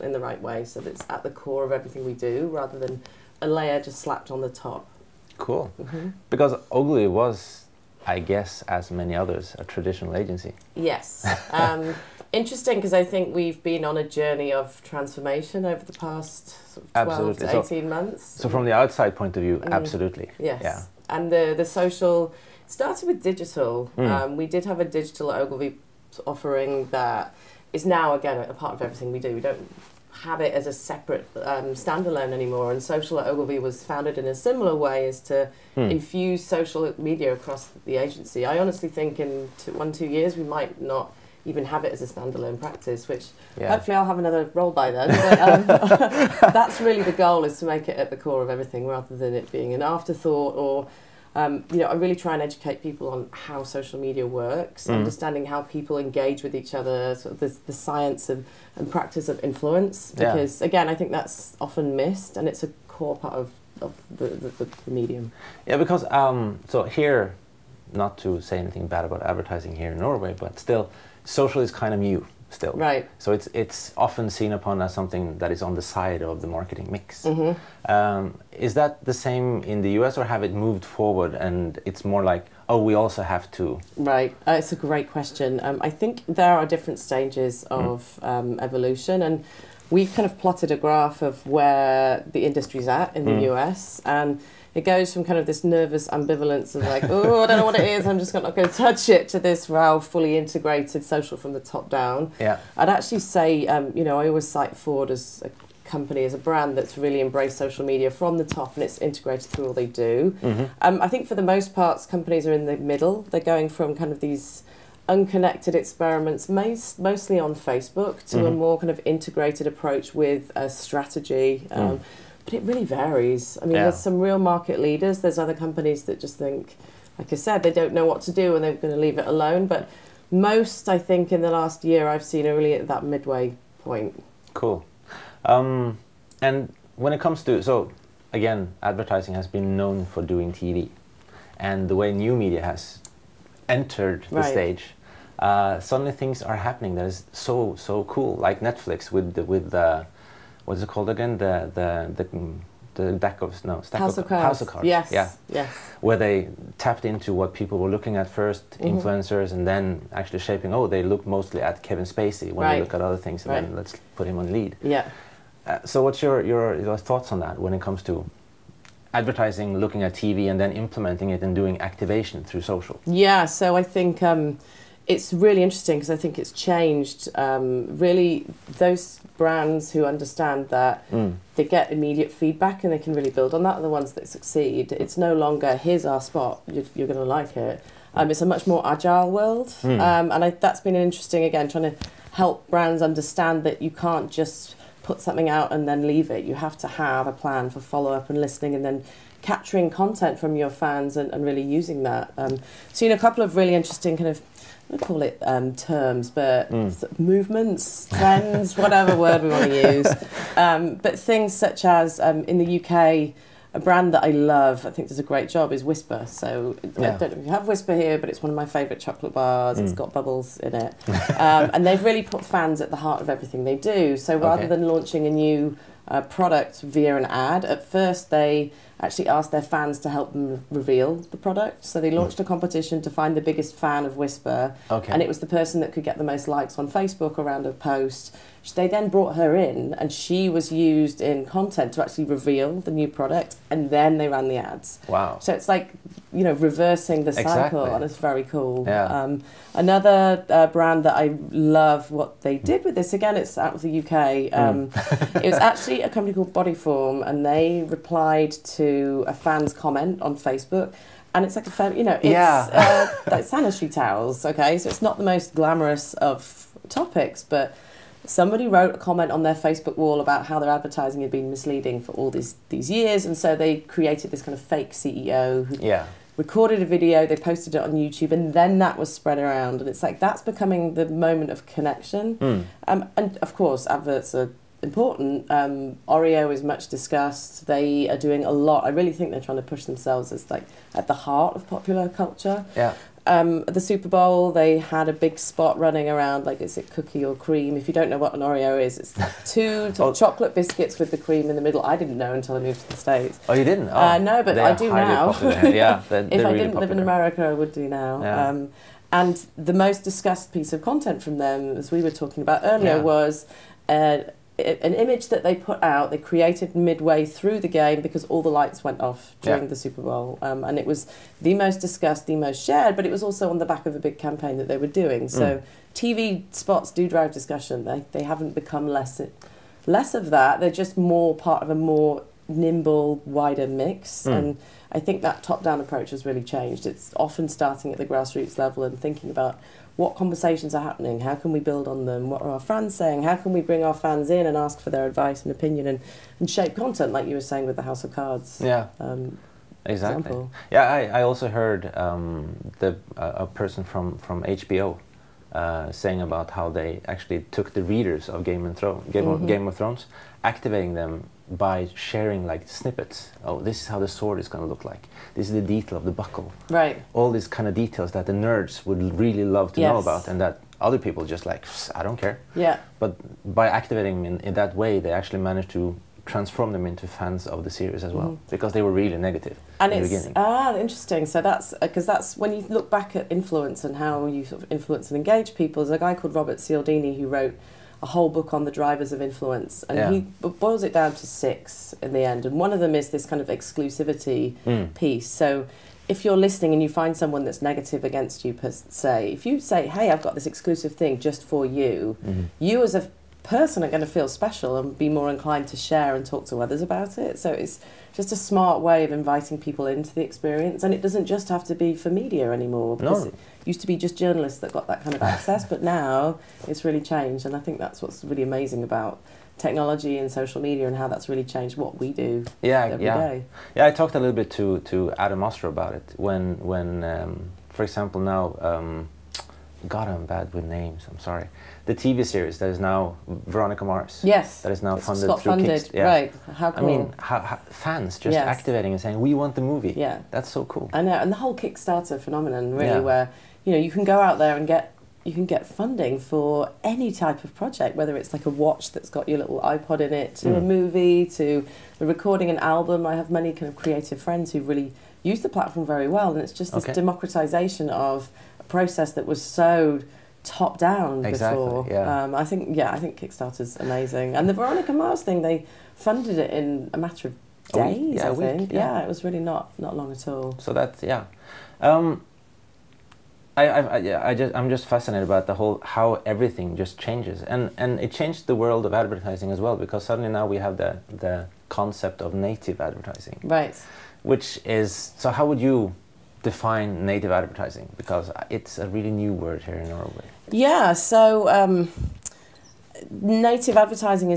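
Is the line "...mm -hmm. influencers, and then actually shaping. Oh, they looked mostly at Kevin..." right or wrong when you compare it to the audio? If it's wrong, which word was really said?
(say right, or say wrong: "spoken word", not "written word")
right.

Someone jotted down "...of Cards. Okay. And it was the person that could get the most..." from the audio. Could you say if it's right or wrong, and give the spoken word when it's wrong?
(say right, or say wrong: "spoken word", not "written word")
wrong: "Wispa", not "Cards".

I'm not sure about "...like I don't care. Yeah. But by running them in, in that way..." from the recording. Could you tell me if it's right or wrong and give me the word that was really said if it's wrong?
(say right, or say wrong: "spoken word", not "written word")
wrong: "activating", not "running".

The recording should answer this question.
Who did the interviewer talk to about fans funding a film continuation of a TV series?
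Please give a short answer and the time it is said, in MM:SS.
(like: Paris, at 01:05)
Adam Ostrow, at 07:05.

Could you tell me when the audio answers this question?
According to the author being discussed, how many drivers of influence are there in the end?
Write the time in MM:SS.
06:31.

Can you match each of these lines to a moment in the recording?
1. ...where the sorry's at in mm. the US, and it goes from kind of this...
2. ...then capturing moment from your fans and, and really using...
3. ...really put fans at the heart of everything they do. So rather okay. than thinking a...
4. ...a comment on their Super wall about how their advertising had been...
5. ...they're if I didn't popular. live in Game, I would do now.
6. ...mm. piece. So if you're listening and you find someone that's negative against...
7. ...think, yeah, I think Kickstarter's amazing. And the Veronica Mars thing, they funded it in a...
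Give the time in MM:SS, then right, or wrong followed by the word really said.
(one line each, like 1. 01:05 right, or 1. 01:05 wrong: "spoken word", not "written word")
1. 01:31 wrong: "industry", not "sorry"
2. 03:18 wrong: "content", not "moment"
3. 03:42 wrong: "launching", not "thinking"
4. 04:28 wrong: "Facebook", not "Super"
5. 05:06 wrong: "America", not "Game"
6. 06:34 right
7. 07:42 right.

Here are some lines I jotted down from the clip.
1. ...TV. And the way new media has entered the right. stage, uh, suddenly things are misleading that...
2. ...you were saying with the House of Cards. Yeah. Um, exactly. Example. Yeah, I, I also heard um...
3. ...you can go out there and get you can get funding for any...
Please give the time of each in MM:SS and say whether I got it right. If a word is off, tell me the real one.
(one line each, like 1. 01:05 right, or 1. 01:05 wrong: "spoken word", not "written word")
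1. 02:20 wrong: "happening", not "misleading"
2. 05:47 right
3. 07:23 right.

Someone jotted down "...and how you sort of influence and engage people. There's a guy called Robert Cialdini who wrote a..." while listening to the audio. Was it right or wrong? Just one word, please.
right.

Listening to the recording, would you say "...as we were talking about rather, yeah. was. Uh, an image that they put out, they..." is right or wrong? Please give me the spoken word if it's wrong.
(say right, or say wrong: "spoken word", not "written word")
wrong: "earlier", not "rather".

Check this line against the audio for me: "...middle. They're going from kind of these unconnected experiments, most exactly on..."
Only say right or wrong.
wrong.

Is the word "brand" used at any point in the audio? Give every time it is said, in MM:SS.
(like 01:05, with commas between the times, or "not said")
01:46, 02:59, 03:12, 03:33, 04:10.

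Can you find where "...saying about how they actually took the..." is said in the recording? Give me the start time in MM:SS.
05:55.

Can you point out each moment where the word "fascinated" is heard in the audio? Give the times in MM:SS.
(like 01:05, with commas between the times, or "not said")
07:54.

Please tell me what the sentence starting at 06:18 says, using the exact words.
because they were really negative and in the beginning.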